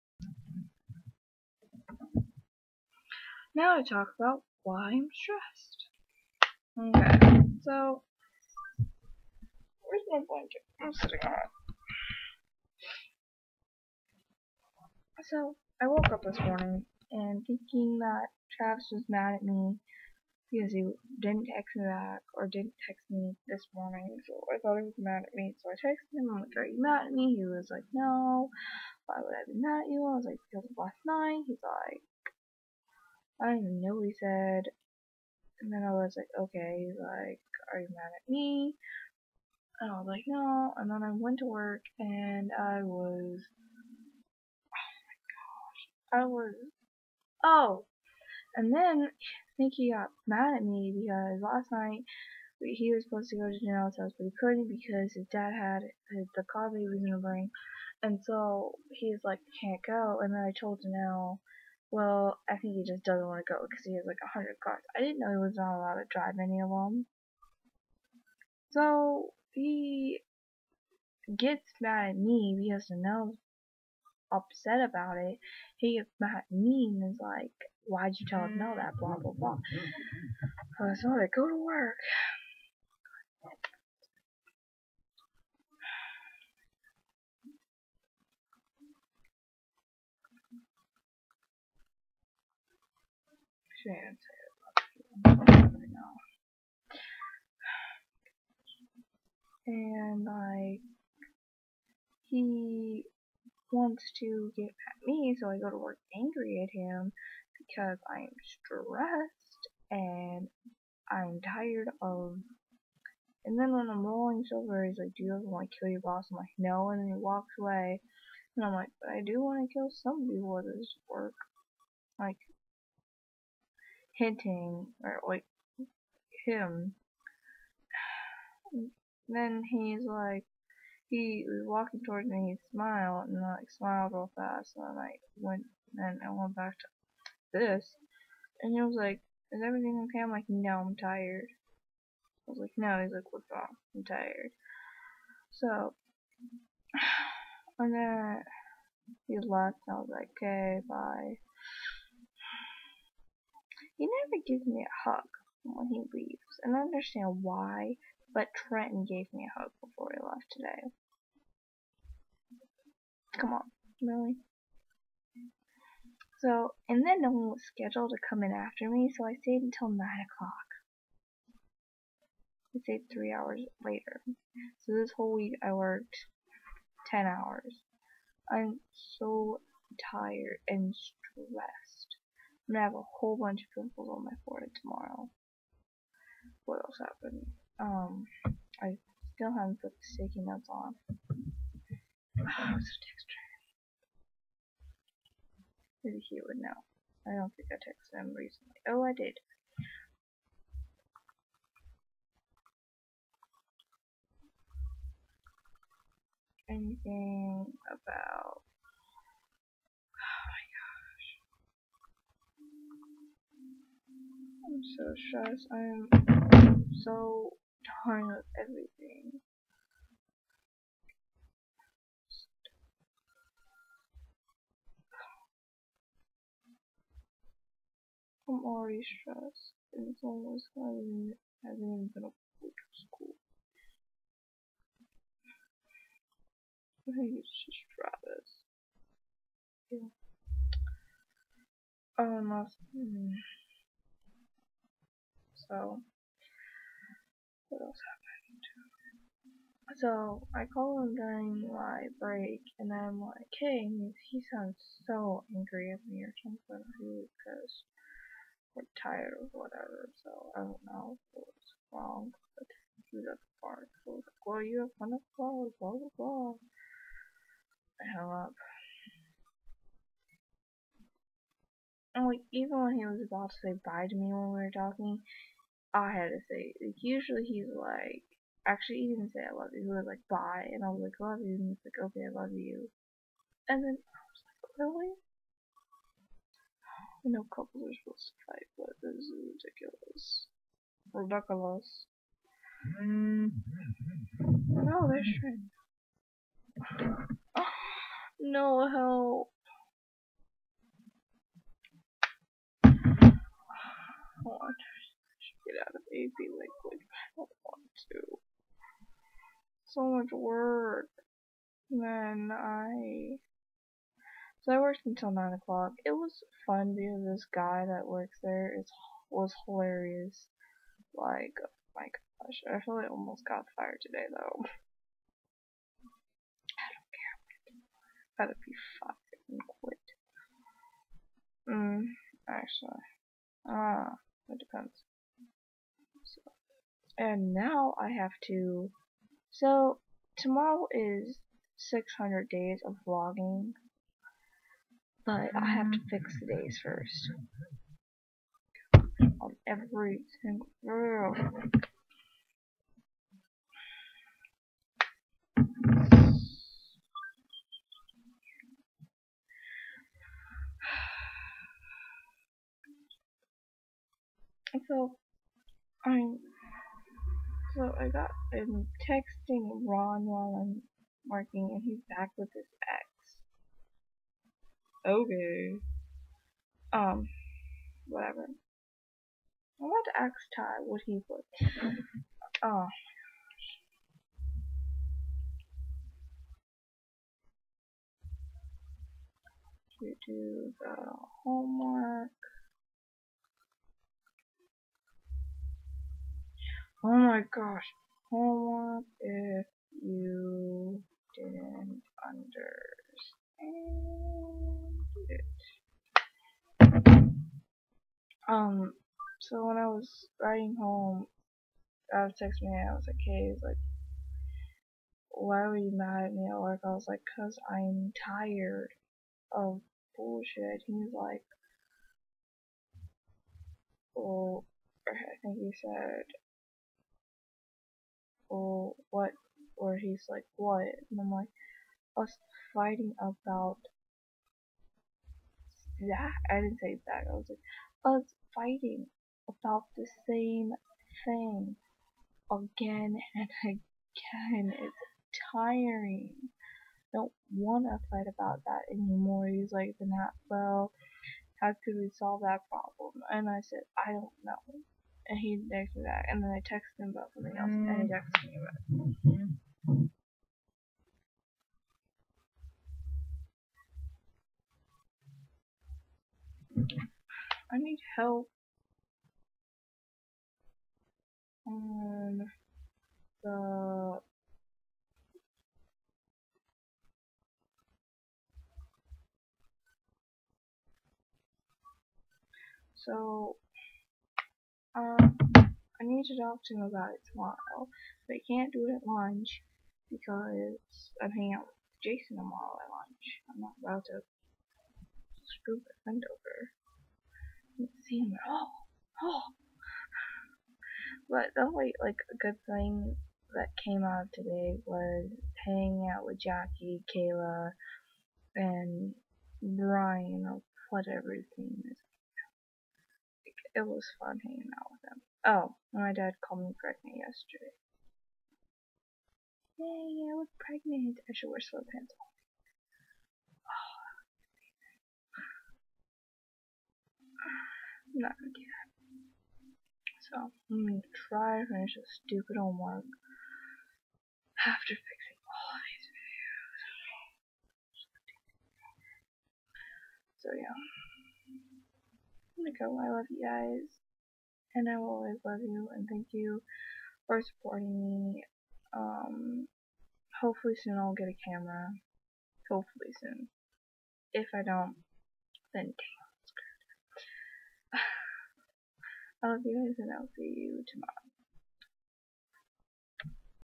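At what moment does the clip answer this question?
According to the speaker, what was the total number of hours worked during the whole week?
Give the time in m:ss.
2:57.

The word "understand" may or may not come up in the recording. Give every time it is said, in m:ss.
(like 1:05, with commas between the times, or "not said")
2:36, 6:42.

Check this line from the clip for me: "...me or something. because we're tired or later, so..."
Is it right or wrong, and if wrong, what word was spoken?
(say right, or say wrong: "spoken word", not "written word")
wrong: "whatever", not "later".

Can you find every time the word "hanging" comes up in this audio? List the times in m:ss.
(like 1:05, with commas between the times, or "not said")
8:11, 8:25, 8:34.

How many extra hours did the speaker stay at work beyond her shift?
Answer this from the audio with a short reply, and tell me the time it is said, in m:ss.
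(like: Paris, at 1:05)
3, at 2:53.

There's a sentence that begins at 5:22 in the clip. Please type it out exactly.
I feel like I almost got fired today though.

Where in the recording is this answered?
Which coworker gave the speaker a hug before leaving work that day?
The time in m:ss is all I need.
2:38.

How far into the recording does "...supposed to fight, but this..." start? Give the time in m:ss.
4:48.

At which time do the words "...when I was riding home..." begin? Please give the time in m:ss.
6:49.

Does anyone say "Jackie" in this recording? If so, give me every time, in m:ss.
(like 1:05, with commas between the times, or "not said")
8:26.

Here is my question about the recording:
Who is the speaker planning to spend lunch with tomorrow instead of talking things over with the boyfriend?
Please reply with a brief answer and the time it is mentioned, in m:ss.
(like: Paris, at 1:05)
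Jason, at 8:12.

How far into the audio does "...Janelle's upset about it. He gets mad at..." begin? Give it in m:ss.
1:12.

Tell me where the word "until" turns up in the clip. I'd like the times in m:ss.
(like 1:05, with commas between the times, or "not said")
2:49, 5:15.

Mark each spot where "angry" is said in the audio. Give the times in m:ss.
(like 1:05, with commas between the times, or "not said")
1:46, 4:15.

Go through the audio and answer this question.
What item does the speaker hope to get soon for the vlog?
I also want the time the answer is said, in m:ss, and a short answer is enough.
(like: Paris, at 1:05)
A camera, at 9:11.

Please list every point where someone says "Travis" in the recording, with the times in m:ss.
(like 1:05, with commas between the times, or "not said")
0:18, 3:57.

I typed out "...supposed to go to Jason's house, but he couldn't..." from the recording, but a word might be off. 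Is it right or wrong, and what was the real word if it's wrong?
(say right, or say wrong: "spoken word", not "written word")
wrong: "Janelle", not "Jason".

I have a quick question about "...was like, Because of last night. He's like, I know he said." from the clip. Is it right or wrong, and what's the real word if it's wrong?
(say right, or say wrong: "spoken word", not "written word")
right.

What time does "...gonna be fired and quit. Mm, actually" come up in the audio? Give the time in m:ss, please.
5:27.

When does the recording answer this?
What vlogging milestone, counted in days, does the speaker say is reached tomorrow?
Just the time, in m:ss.
5:41.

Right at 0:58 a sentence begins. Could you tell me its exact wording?
And so he's like, can't go.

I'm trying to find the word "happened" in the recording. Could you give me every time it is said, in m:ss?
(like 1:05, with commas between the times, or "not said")
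3:07, 4:08.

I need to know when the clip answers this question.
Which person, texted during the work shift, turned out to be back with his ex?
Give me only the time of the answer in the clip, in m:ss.
6:09.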